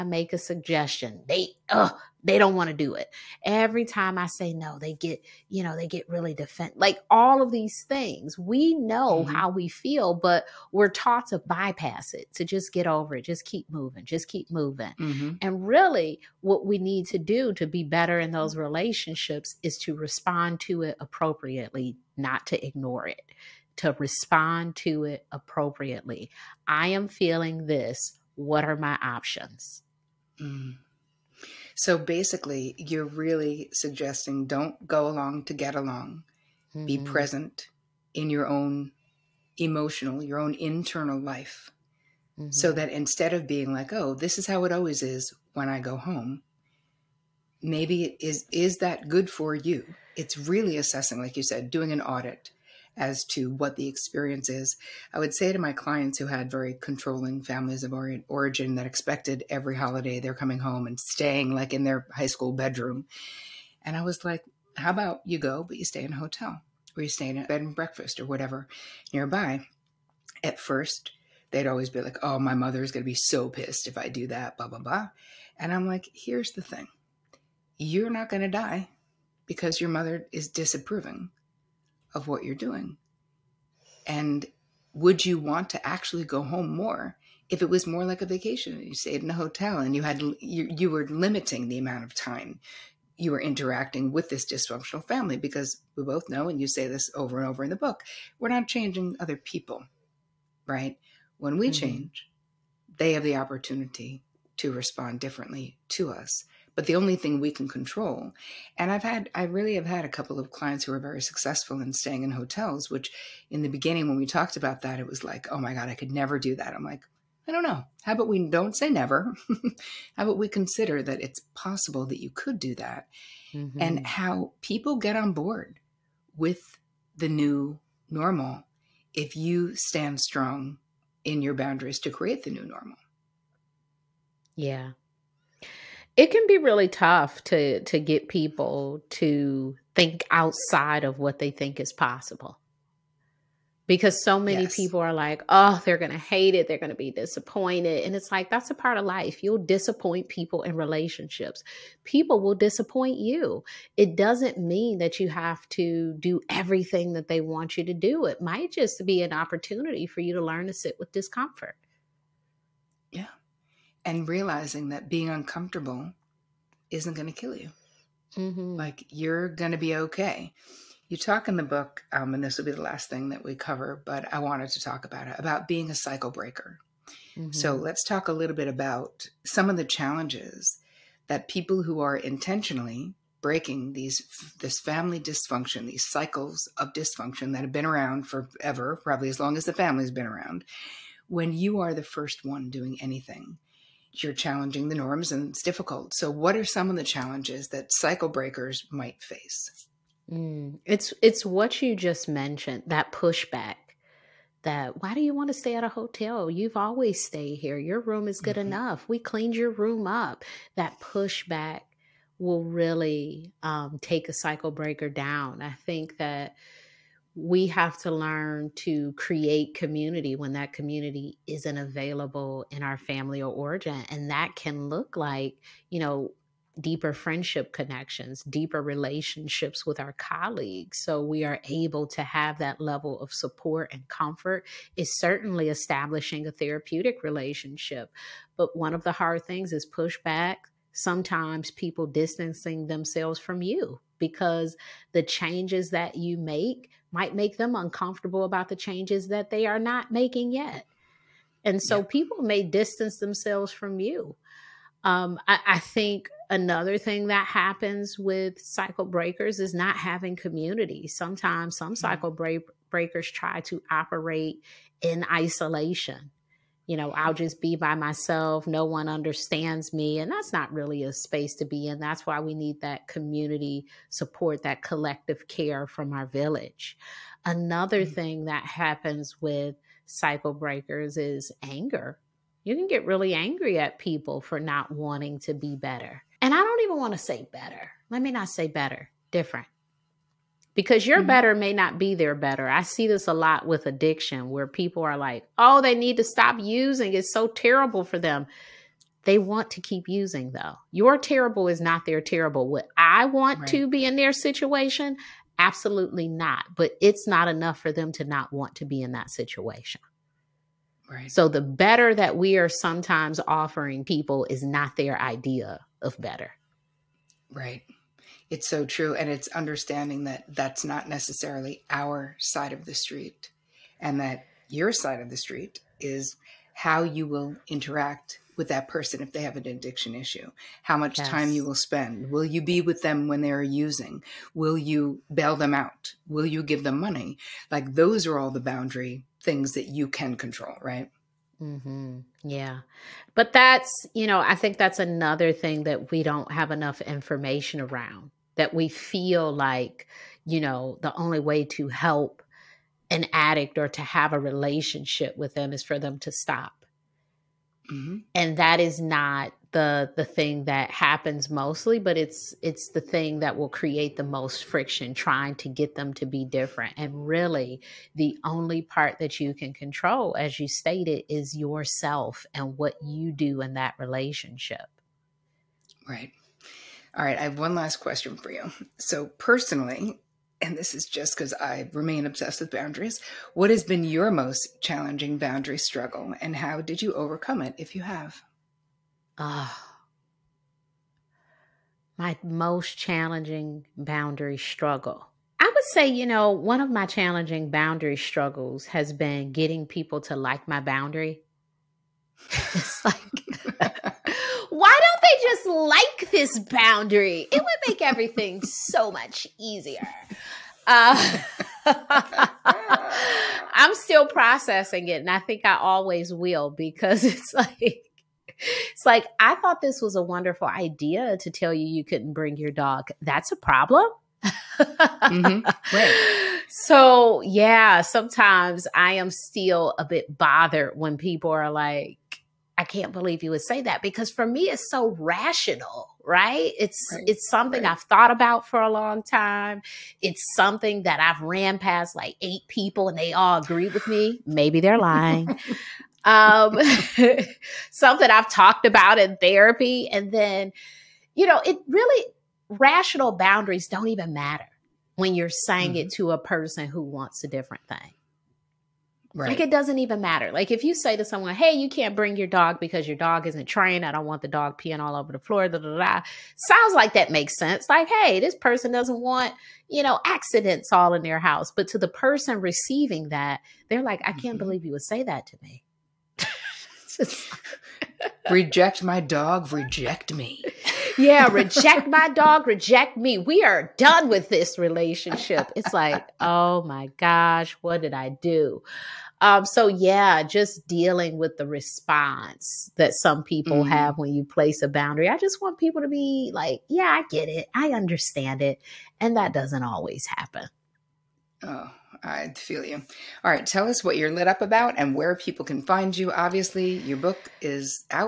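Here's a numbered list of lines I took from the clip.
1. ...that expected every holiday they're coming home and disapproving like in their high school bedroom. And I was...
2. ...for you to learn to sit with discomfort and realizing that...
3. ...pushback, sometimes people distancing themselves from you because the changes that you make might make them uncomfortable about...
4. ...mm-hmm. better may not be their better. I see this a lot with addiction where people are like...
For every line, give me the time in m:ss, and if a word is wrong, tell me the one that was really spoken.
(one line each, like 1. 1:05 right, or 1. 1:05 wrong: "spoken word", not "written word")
1. 0:58 wrong: "staying", not "disapproving"
2. 2:40 right
3. 3:59 right
4. 4:51 right.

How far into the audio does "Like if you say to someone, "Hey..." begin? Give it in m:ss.
7:40.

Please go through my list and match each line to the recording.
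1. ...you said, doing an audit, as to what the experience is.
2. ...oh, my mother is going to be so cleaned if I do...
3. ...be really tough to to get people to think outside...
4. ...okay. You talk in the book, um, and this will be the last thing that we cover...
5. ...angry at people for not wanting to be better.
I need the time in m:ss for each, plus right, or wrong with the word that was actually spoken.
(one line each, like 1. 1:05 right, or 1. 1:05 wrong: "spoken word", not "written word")
1. 0:51 right
2. 1:12 wrong: "pissed", not "cleaned"
3. 2:16 right
4. 2:49 right
5. 4:43 right.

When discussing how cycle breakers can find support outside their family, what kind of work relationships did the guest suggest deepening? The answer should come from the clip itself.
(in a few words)
Colleagues.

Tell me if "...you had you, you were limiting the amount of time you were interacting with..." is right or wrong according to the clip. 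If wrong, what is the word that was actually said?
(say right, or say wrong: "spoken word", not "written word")
right.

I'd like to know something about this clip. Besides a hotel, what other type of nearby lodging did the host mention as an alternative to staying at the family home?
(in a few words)
Bed and breakfast.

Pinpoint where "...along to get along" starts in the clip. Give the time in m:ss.
0:35.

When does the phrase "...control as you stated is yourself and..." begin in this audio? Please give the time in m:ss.
6:09.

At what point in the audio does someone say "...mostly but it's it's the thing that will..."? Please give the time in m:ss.
6:01.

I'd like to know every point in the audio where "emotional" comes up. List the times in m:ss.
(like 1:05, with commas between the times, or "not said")
0:39.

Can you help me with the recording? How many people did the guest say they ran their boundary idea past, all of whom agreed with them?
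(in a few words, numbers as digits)
8.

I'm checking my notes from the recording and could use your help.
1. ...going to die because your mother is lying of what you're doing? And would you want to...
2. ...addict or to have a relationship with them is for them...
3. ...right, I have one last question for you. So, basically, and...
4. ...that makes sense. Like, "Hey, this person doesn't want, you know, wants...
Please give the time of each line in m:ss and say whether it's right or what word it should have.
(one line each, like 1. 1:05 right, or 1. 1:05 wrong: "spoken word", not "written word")
1. 1:18 wrong: "disapproving", not "lying"
2. 5:53 right
3. 6:17 wrong: "personally", not "basically"
4. 7:47 wrong: "accidents", not "wants".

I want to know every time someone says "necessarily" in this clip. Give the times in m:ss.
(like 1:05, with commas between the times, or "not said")
5:21.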